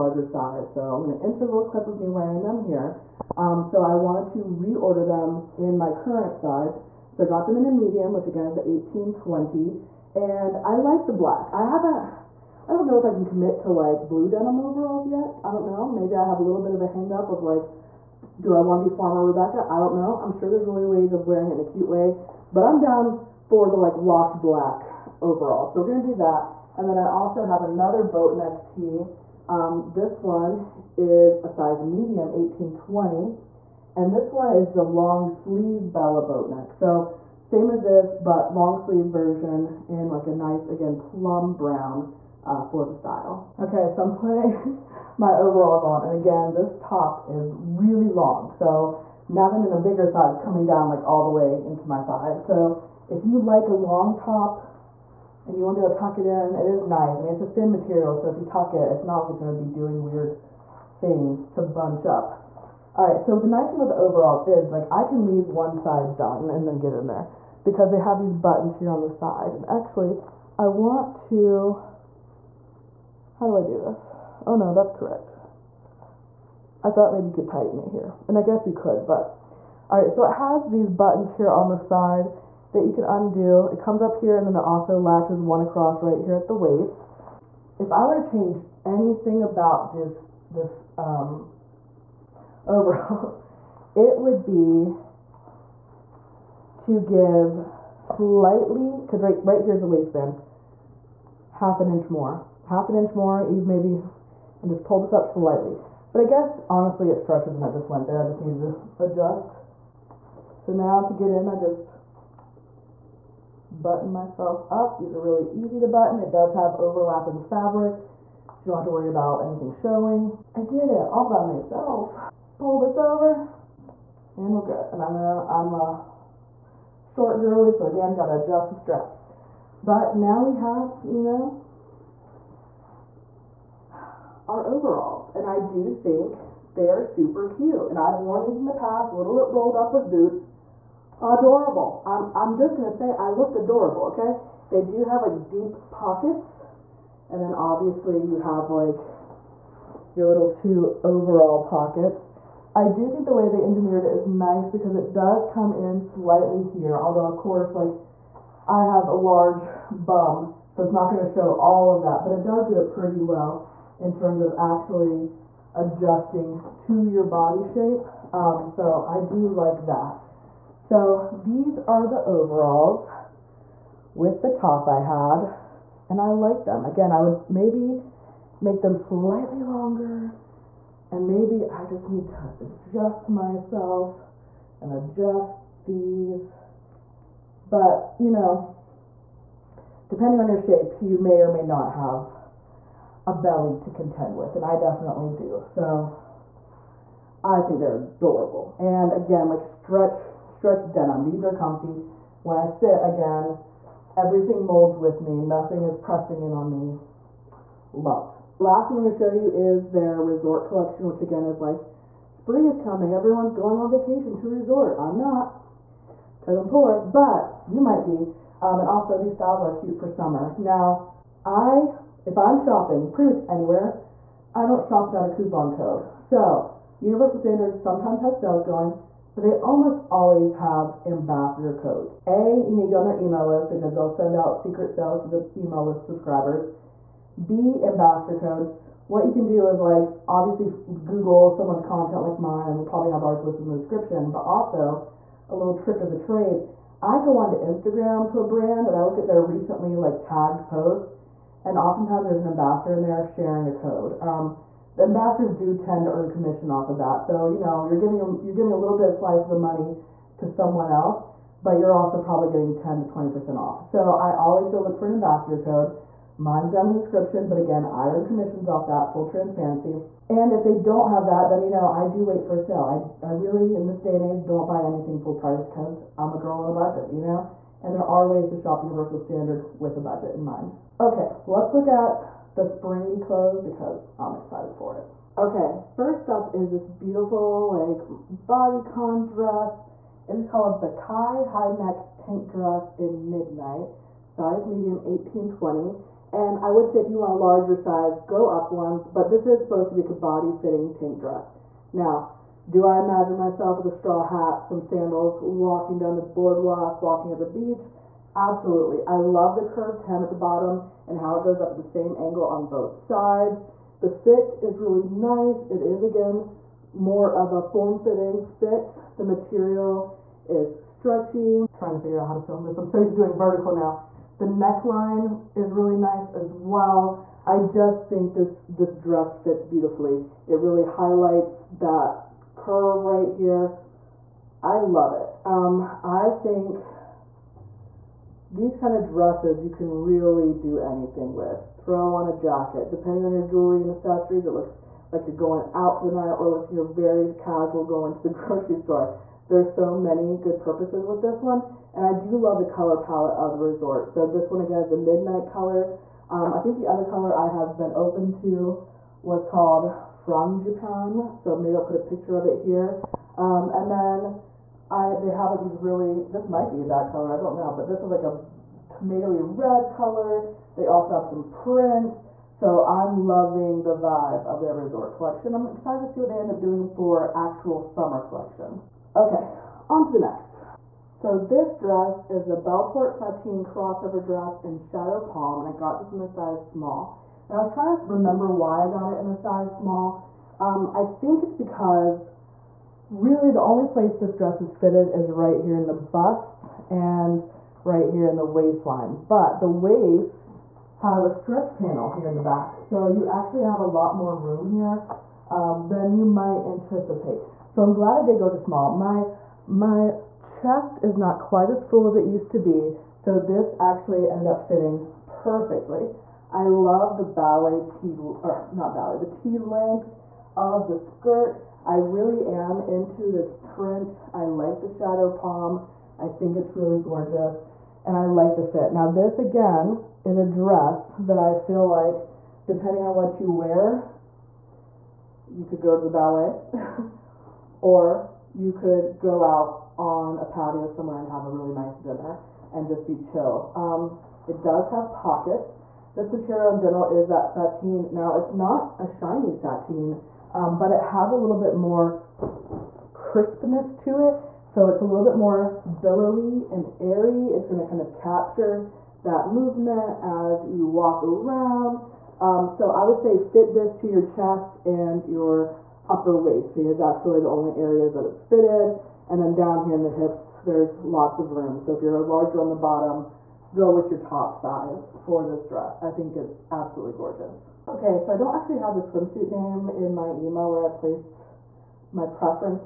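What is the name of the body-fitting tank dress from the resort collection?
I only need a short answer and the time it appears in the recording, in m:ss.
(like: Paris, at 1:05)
Kai High Neck Tank Dress, at 4:50.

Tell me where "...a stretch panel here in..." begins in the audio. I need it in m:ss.
6:41.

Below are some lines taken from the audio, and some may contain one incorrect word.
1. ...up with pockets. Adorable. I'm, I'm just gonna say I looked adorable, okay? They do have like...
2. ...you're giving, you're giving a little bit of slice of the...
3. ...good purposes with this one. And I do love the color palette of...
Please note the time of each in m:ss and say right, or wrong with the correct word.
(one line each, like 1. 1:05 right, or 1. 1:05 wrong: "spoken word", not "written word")
1. 2:19 wrong: "boots", not "pockets"
2. 4:17 right
3. 5:50 right.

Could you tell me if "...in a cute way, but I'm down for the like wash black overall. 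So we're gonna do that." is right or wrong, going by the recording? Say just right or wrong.
right.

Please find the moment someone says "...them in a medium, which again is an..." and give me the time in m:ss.
0:07.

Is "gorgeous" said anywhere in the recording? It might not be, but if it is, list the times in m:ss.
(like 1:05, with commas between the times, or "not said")
7:07, 7:57.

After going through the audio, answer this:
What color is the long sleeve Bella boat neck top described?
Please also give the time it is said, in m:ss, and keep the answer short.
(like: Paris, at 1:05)
Plum brown, at 0:40.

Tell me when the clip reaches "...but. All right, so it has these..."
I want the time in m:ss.
1:19.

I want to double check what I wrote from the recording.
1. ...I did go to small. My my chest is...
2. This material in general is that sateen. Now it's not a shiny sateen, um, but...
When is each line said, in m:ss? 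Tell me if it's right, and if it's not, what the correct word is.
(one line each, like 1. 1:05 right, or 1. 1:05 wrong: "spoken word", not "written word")
1. 6:48 right
2. 7:26 right.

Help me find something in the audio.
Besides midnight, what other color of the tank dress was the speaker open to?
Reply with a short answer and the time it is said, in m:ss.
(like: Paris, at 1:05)
Frangipan, at 6:00.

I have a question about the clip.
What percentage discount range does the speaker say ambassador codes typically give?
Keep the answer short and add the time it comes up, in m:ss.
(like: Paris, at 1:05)
10 to 20%, at 4:22.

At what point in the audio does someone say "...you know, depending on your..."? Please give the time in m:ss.
3:08.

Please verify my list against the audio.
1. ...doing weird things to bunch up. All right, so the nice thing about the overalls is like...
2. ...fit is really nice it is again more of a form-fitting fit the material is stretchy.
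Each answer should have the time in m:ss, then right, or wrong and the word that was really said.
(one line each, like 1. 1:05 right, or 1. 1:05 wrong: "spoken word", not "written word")
1. 0:59 right
2. 5:14 right.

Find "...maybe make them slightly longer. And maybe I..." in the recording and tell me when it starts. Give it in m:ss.
2:57.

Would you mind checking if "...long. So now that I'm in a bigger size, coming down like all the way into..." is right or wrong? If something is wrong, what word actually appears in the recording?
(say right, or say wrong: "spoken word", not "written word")
right.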